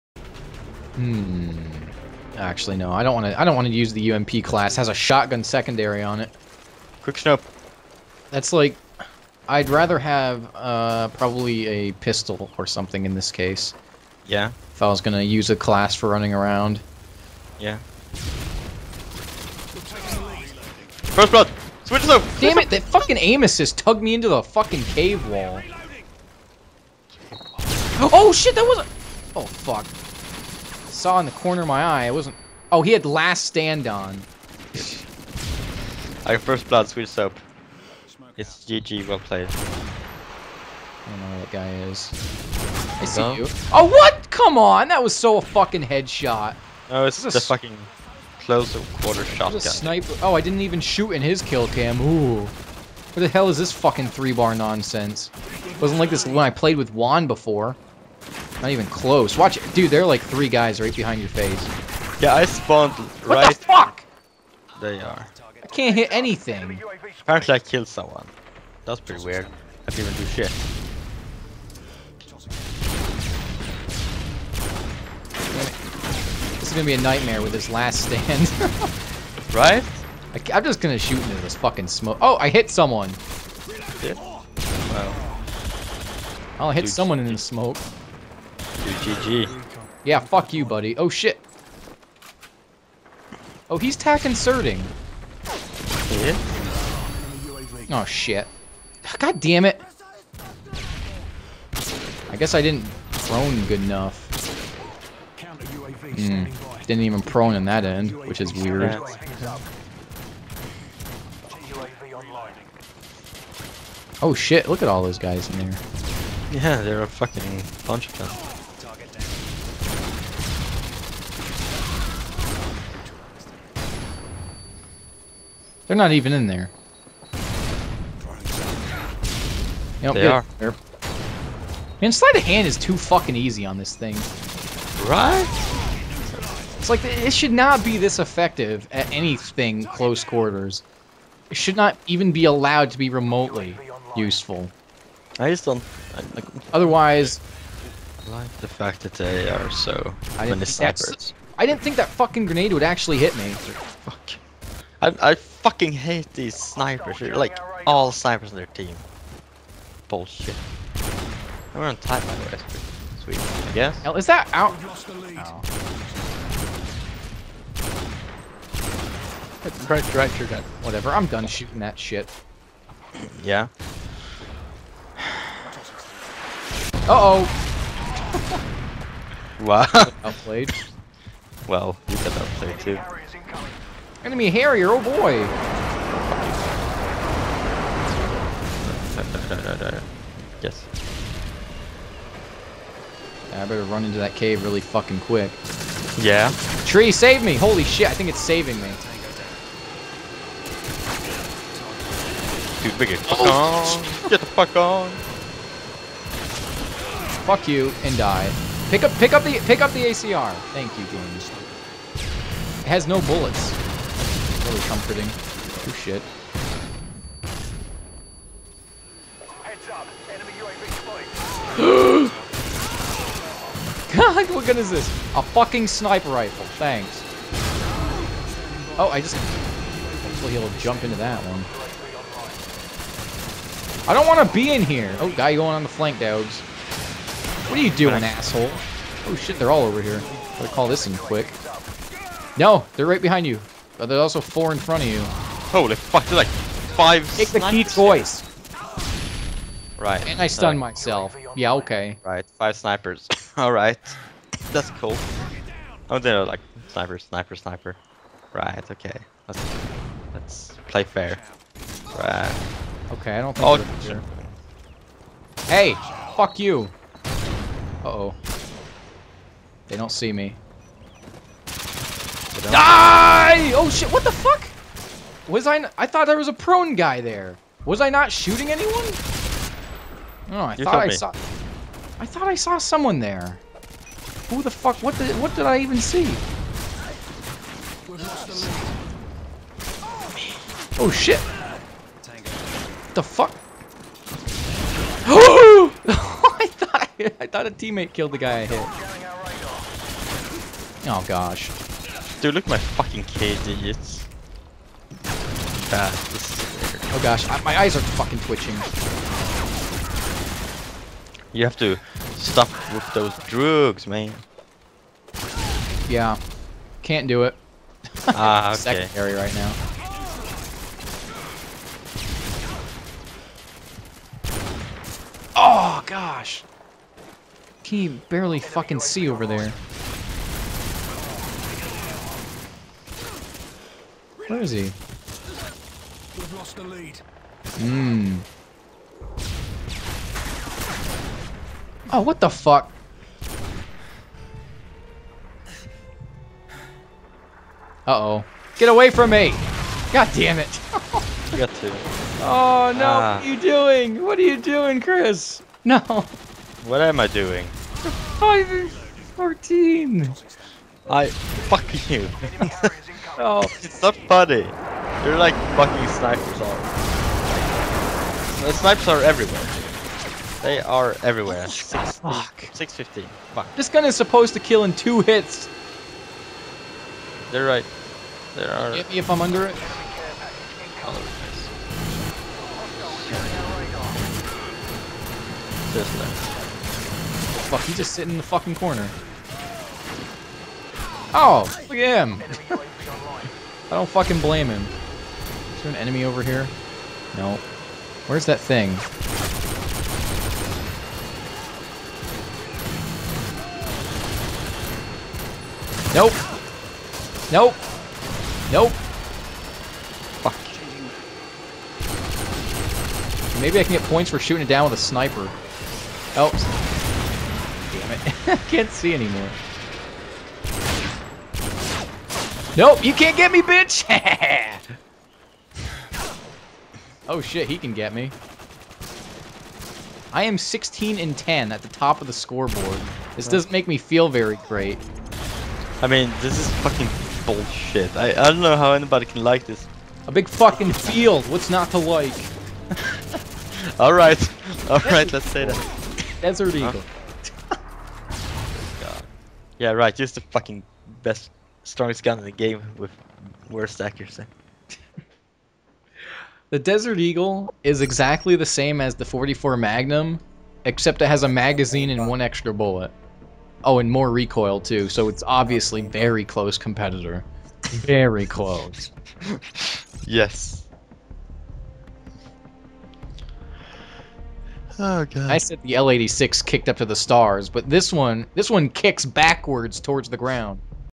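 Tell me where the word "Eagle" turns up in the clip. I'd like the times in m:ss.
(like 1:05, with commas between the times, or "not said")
7:26, 7:37.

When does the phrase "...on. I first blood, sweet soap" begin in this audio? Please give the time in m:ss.
0:33.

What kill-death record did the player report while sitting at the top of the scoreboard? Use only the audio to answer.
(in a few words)
16 and 10.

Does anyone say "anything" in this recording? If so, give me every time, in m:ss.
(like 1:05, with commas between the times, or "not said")
1:06, 2:19.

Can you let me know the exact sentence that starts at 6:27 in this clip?
Fuck, he's just sitting in the fucking corner.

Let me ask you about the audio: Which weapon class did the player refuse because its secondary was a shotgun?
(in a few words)
UMP.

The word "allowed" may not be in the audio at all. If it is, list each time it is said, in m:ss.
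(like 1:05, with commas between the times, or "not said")
2:22.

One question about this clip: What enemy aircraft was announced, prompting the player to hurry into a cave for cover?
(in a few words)
Harrier.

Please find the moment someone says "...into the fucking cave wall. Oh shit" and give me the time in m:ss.
0:24.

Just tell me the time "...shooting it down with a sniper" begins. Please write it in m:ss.
6:54.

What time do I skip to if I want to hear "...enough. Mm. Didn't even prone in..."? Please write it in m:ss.
1:43.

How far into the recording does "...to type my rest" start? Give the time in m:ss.
2:41.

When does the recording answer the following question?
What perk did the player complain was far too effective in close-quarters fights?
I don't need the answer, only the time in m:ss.
2:12.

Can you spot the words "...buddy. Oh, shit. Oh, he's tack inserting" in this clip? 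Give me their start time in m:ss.
1:30.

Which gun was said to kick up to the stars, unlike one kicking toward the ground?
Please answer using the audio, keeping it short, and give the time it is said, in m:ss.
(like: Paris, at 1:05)
L86, at 7:55.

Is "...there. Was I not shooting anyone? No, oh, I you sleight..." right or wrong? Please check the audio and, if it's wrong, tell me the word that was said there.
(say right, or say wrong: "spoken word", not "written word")
wrong: "thought", not "sleight".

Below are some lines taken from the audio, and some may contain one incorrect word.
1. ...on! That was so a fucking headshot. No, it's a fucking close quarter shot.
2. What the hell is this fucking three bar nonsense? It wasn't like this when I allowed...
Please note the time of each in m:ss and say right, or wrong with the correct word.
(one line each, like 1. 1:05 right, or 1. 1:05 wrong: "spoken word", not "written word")
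1. 0:44 right
2. 0:52 wrong: "played", not "allowed".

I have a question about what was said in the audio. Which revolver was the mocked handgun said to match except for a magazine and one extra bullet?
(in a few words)
44 Magnum.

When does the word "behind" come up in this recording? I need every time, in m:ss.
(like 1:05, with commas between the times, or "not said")
1:00, 4:03.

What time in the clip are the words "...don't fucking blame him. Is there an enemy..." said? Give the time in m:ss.
6:33.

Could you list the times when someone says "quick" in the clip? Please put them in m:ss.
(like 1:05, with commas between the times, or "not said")
0:07, 3:15, 4:01.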